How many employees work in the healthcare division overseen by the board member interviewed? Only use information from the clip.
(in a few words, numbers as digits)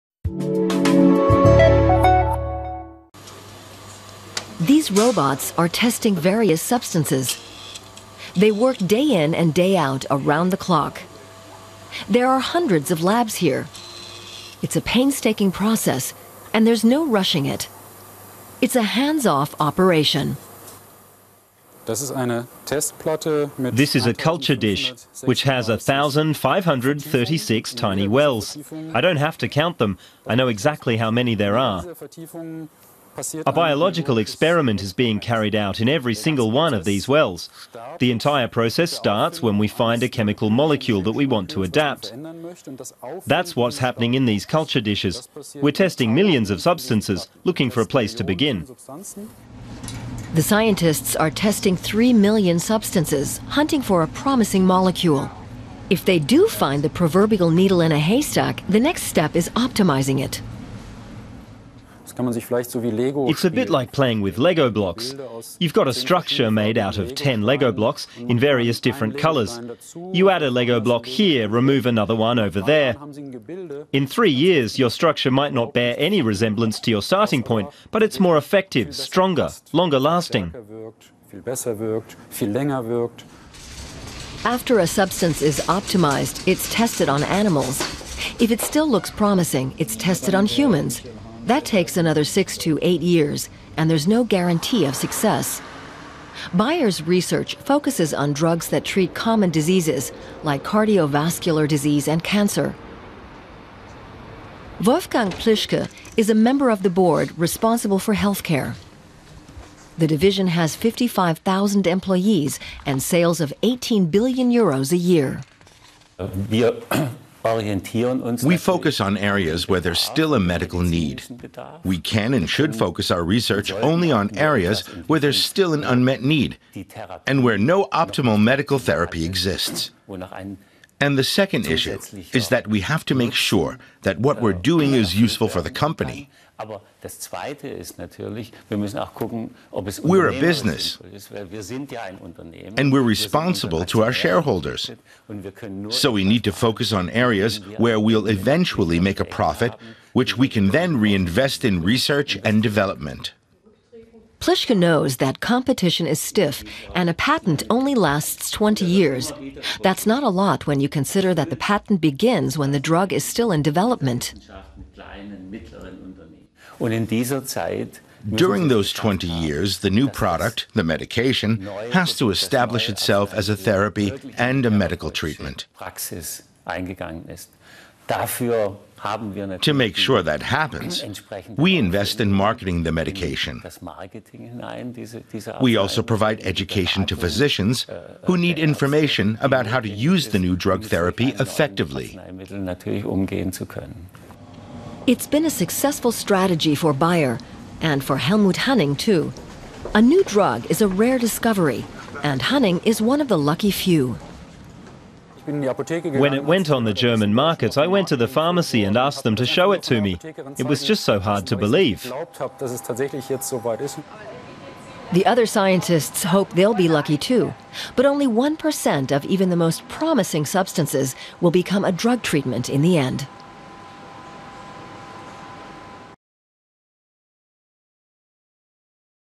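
55,000.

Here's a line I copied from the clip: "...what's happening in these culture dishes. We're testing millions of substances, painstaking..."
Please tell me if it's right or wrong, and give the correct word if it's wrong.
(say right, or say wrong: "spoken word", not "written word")
wrong: "looking", not "painstaking".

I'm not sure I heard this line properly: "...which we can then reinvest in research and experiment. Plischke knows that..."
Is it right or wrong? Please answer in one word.
wrong.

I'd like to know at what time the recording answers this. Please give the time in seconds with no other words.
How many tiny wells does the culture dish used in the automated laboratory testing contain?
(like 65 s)
25 s.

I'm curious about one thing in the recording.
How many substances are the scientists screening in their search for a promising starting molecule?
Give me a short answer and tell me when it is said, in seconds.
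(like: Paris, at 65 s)
3 million, at 51 s.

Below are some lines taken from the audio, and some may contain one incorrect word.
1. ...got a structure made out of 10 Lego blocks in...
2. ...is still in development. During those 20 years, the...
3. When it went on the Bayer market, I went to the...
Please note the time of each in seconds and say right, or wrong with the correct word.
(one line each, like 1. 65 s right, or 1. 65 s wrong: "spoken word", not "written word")
1. 65 s right
2. 163 s right
3. 205 s wrong: "German", not "Bayer".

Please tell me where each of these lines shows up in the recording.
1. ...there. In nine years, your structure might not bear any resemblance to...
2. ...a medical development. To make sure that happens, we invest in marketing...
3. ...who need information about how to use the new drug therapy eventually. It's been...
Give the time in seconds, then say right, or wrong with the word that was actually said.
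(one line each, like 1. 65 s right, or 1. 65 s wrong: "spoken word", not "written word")
1. 72 s wrong: "three", not "nine"
2. 174 s wrong: "treatment", not "development"
3. 188 s wrong: "effectively", not "eventually".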